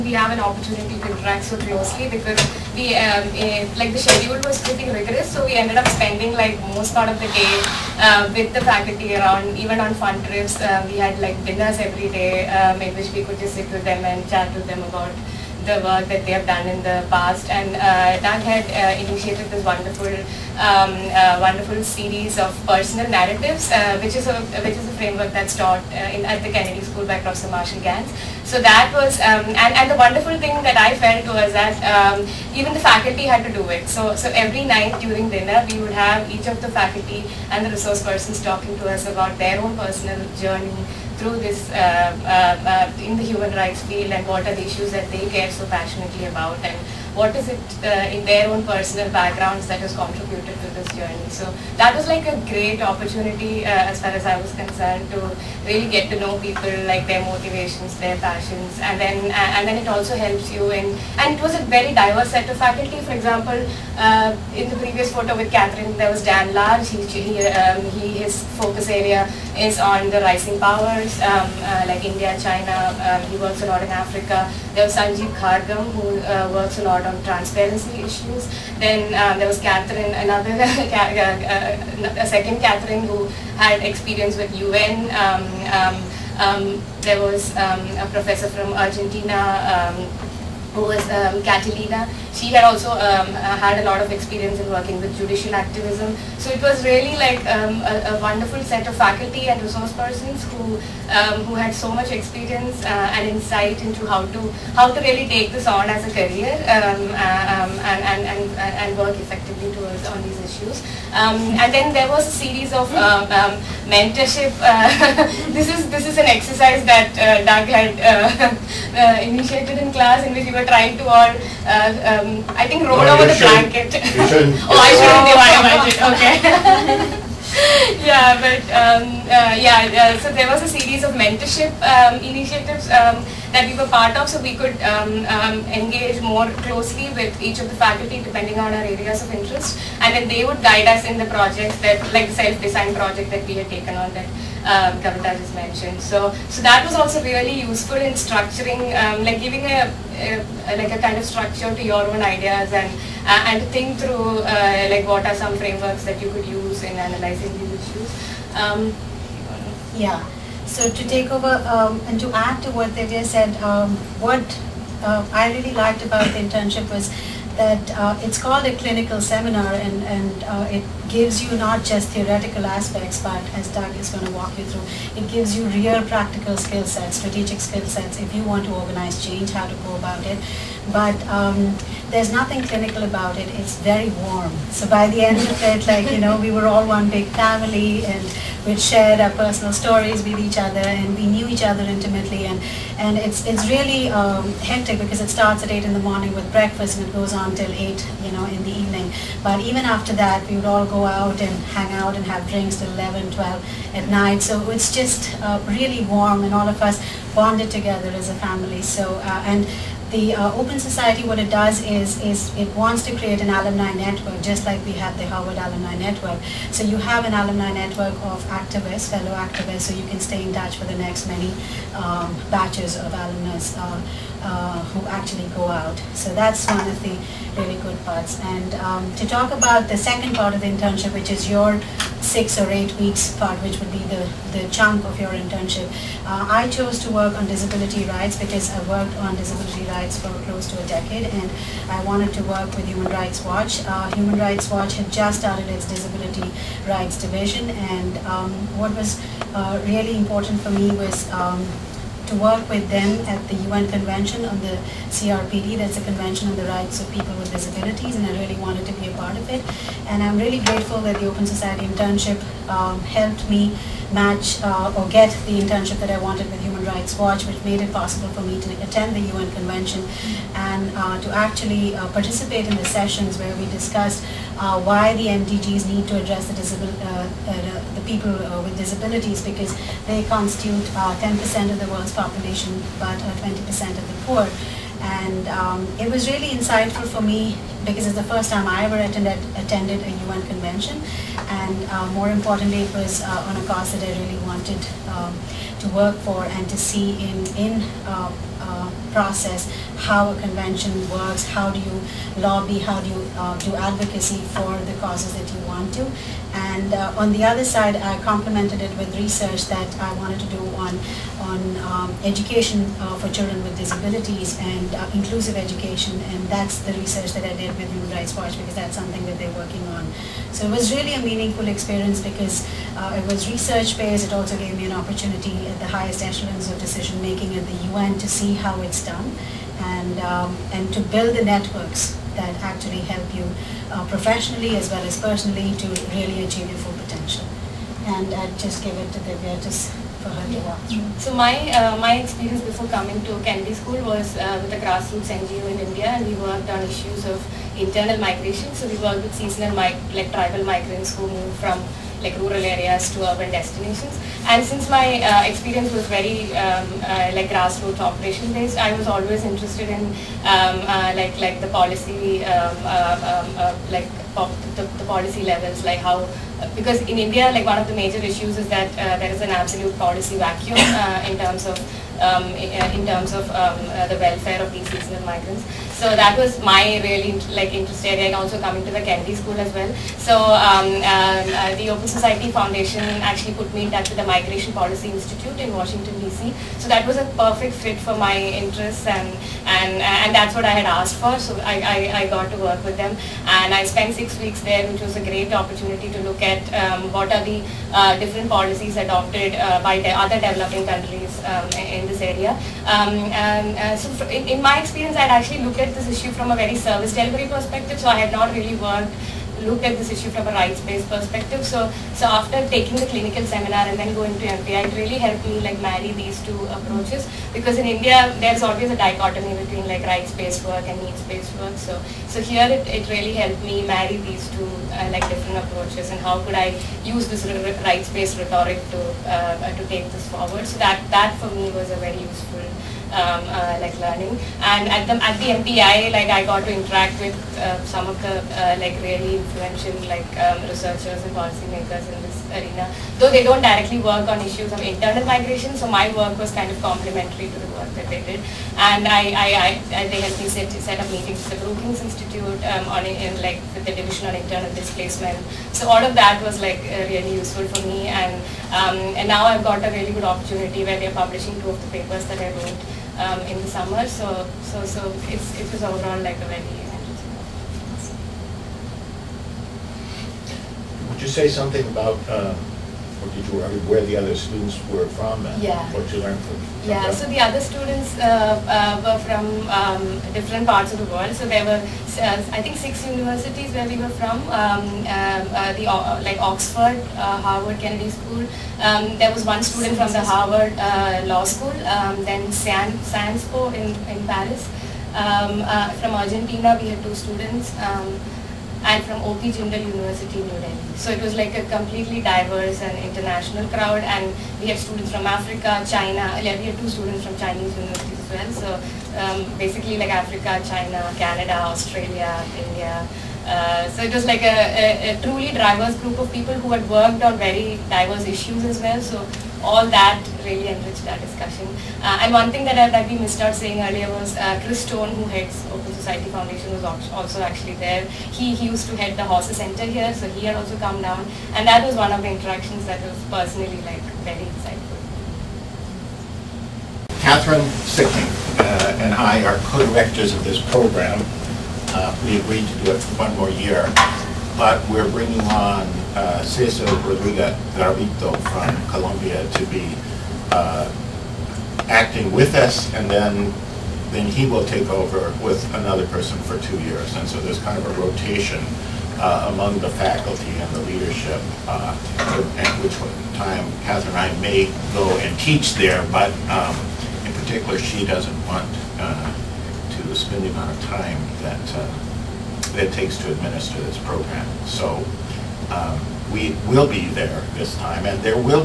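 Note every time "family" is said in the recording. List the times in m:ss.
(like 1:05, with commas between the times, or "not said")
3:07, 3:28.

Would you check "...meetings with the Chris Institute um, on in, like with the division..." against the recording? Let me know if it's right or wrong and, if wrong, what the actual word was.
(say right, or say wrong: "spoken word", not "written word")
wrong: "Brookings", not "Chris".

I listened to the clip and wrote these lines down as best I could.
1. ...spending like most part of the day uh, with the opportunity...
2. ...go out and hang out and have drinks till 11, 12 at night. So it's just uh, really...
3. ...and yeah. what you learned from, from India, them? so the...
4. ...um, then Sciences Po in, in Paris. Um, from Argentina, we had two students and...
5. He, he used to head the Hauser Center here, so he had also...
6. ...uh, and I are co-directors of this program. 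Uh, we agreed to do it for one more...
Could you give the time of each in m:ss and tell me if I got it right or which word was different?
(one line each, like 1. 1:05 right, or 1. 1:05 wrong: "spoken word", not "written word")
1. 0:05 wrong: "faculty", not "opportunity"
2. 3:20 right
3. 7:55 wrong: "Yeah", not "India"
4. 8:11 right
5. 8:48 right
6. 8:58 right.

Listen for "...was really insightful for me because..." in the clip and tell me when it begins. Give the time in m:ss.
4:46.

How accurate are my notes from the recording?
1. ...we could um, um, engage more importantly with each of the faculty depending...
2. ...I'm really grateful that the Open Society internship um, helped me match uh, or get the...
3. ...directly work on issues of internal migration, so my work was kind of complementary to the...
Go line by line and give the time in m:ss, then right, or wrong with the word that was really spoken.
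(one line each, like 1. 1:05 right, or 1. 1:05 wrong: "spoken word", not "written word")
1. 2:14 wrong: "closely", not "importantly"
2. 4:20 right
3. 7:23 right.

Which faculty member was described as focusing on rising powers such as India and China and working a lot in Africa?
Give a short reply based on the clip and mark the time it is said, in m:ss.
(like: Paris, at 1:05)
Dan Large, at 1:06.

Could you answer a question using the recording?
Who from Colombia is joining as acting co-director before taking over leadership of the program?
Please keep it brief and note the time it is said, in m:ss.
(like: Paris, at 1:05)
Cesar Rodriguez Garavito, at 9:06.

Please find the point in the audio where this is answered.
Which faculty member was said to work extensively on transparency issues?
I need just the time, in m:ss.
1:14.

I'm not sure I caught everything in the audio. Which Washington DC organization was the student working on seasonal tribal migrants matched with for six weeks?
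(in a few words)
Migration Policy Institute.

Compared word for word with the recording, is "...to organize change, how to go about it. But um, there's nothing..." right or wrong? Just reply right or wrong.
right.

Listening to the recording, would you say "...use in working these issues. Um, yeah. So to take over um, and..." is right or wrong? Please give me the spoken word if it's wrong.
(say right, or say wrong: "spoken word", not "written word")
wrong: "analyzing", not "working".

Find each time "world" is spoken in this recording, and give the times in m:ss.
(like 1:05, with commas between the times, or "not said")
4:41, 8:01.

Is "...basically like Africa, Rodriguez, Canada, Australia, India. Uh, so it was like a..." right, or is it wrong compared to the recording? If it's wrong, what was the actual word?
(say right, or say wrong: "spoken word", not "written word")
wrong: "China", not "Rodriguez".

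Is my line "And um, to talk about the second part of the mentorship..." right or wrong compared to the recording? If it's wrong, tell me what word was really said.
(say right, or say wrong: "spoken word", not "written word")
wrong: "internship", not "mentorship".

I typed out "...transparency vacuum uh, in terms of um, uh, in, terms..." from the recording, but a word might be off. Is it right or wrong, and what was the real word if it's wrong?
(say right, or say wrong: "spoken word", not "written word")
wrong: "policy", not "transparency".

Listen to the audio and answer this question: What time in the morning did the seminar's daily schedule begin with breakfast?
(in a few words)
8.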